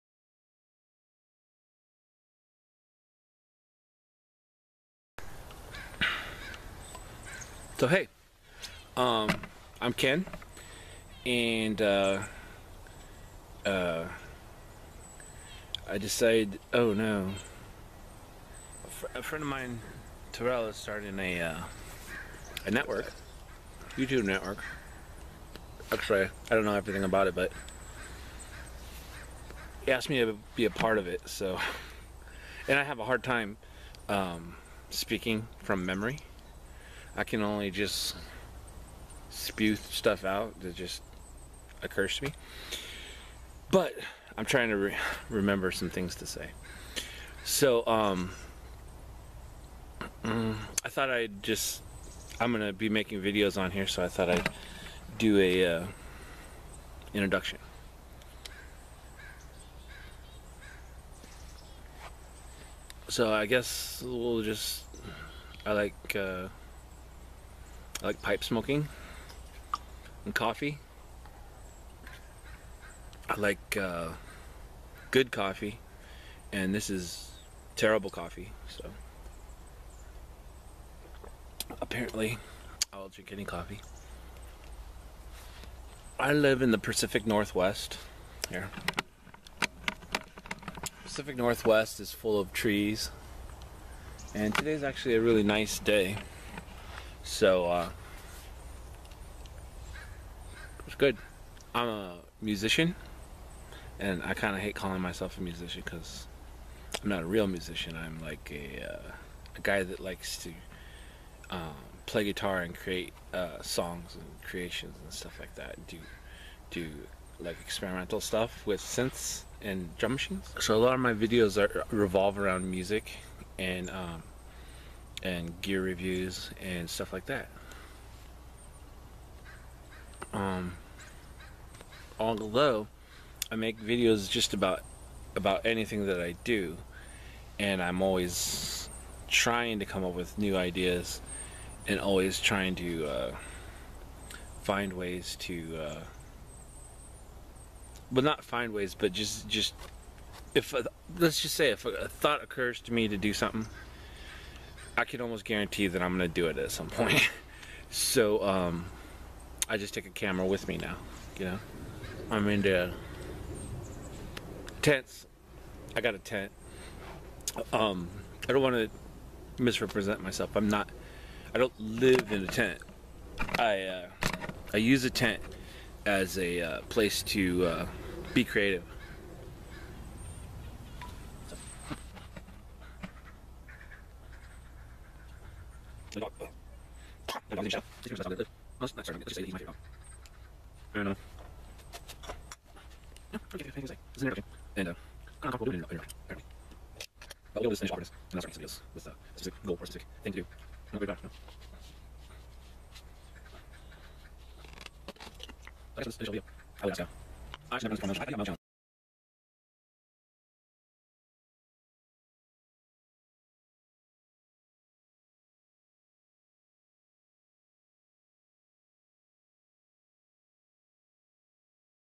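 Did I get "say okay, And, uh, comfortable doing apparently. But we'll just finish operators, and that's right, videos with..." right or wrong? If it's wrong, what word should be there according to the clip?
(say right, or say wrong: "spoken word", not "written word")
right.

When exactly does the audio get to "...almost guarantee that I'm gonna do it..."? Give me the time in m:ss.
2:35.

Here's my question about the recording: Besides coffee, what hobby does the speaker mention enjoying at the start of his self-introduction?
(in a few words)
Pipe smoking.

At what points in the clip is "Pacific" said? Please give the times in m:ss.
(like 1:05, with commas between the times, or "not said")
1:26, 1:31.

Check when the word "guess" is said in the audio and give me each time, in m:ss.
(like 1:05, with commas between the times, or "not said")
1:03, 3:26.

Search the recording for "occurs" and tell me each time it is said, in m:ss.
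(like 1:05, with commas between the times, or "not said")
0:41, 2:32.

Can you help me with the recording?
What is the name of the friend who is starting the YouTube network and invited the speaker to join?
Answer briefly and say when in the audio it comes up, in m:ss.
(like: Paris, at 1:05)
Terrell, at 0:20.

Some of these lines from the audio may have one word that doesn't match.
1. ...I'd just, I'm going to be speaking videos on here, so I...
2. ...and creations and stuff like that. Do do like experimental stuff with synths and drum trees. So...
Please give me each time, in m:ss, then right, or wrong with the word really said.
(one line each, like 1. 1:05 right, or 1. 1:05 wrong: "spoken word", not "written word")
1. 0:51 wrong: "making", not "speaking"
2. 1:54 wrong: "machines", not "trees".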